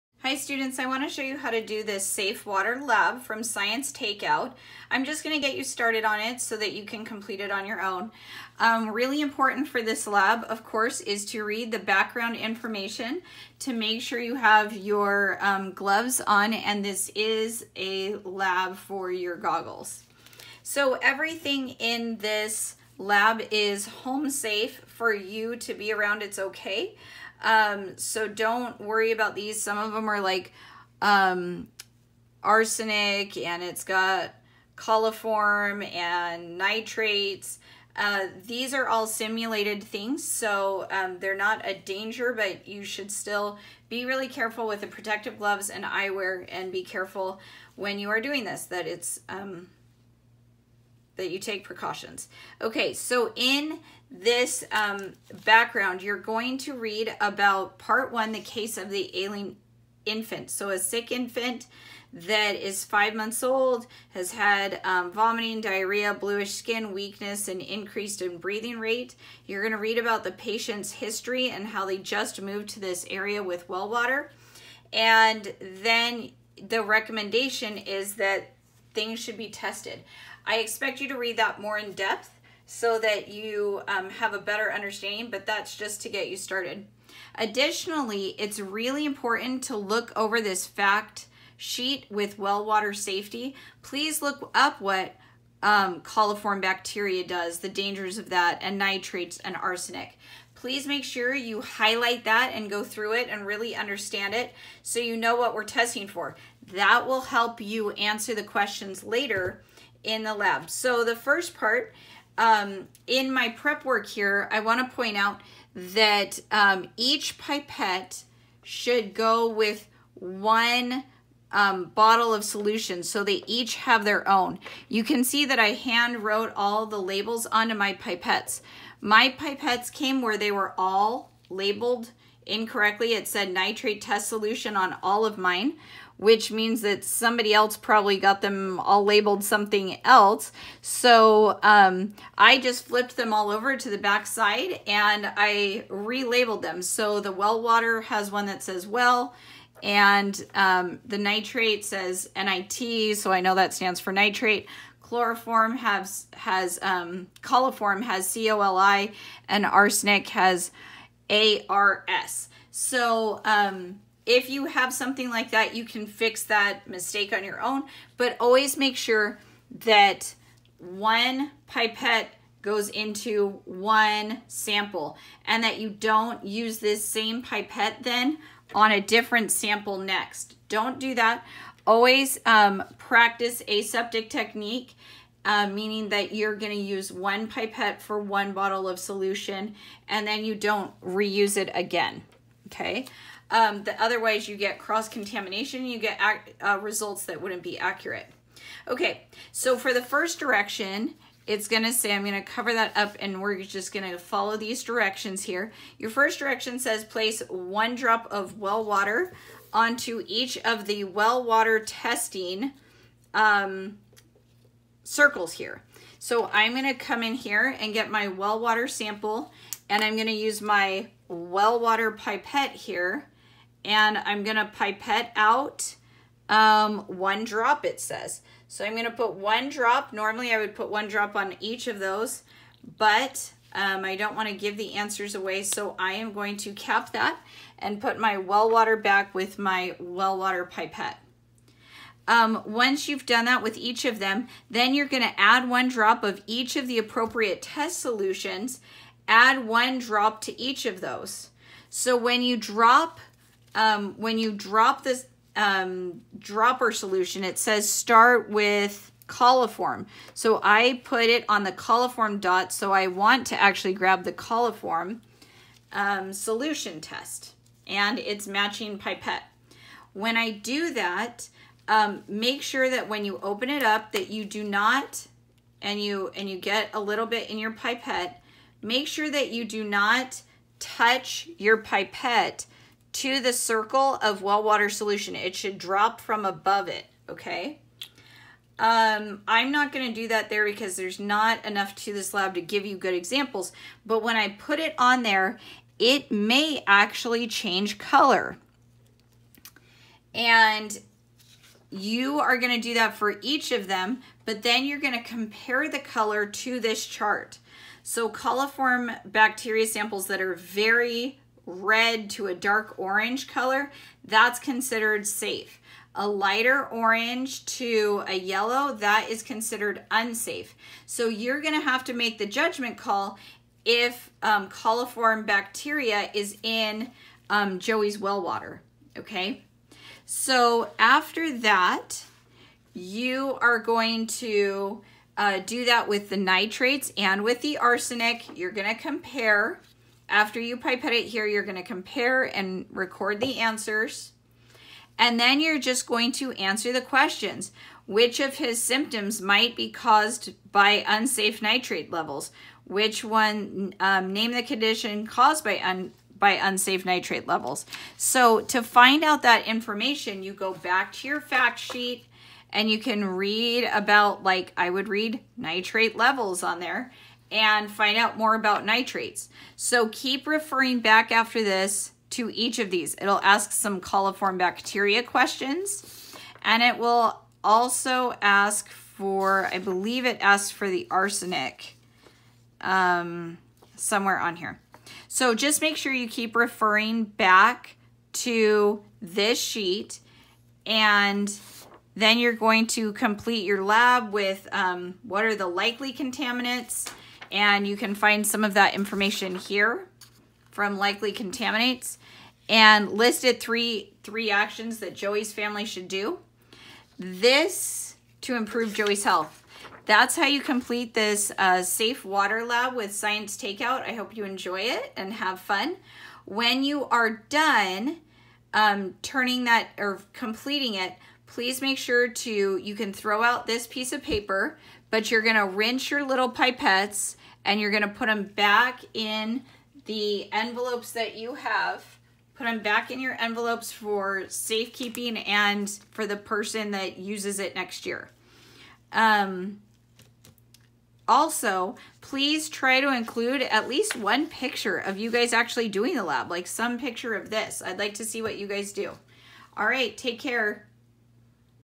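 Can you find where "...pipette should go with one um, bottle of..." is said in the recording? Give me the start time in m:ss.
1:57.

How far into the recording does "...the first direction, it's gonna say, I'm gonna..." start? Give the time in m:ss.
3:19.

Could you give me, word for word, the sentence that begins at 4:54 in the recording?
But when I put it on there, it may actually change color.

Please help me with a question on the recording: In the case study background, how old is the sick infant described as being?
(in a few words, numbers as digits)
5 months.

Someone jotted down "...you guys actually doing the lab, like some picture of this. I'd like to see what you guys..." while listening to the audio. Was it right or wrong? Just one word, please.
right.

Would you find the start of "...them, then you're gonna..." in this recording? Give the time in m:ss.
4:04.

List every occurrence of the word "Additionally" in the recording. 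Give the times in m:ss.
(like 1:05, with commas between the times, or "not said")
1:27.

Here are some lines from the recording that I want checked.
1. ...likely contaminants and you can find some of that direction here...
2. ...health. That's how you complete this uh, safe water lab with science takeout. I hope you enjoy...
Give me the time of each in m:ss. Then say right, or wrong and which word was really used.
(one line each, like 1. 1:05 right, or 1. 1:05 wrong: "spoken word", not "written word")
1. 6:35 wrong: "information", not "direction"
2. 6:49 right.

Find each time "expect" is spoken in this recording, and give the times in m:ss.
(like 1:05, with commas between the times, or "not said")
1:20.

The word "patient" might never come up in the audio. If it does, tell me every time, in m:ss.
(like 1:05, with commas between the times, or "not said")
1:10.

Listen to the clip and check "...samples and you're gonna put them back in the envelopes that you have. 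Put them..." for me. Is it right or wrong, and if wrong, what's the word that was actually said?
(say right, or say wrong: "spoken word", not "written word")
wrong: "pipettes", not "samples".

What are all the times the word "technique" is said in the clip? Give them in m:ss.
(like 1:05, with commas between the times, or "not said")
3:04.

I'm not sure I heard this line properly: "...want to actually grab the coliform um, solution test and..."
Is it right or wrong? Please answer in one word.
right.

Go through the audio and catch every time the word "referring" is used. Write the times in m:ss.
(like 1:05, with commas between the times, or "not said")
6:10, 6:26.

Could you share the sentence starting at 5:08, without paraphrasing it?
So coliform bacteria samples that are very red to a dark orange color, that's considered safe.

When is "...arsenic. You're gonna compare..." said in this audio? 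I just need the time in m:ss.
5:37.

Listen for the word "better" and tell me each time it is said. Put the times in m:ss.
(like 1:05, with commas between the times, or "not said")
1:24.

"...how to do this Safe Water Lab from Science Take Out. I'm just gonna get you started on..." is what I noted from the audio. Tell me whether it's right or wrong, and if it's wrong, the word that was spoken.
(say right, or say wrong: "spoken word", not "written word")
right.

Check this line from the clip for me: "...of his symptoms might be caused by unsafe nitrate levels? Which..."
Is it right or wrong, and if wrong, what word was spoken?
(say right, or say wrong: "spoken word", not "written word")
right.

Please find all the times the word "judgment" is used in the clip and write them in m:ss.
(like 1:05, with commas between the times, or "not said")
5:22.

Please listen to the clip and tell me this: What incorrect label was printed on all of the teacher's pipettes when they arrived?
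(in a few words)
nitrate test solution.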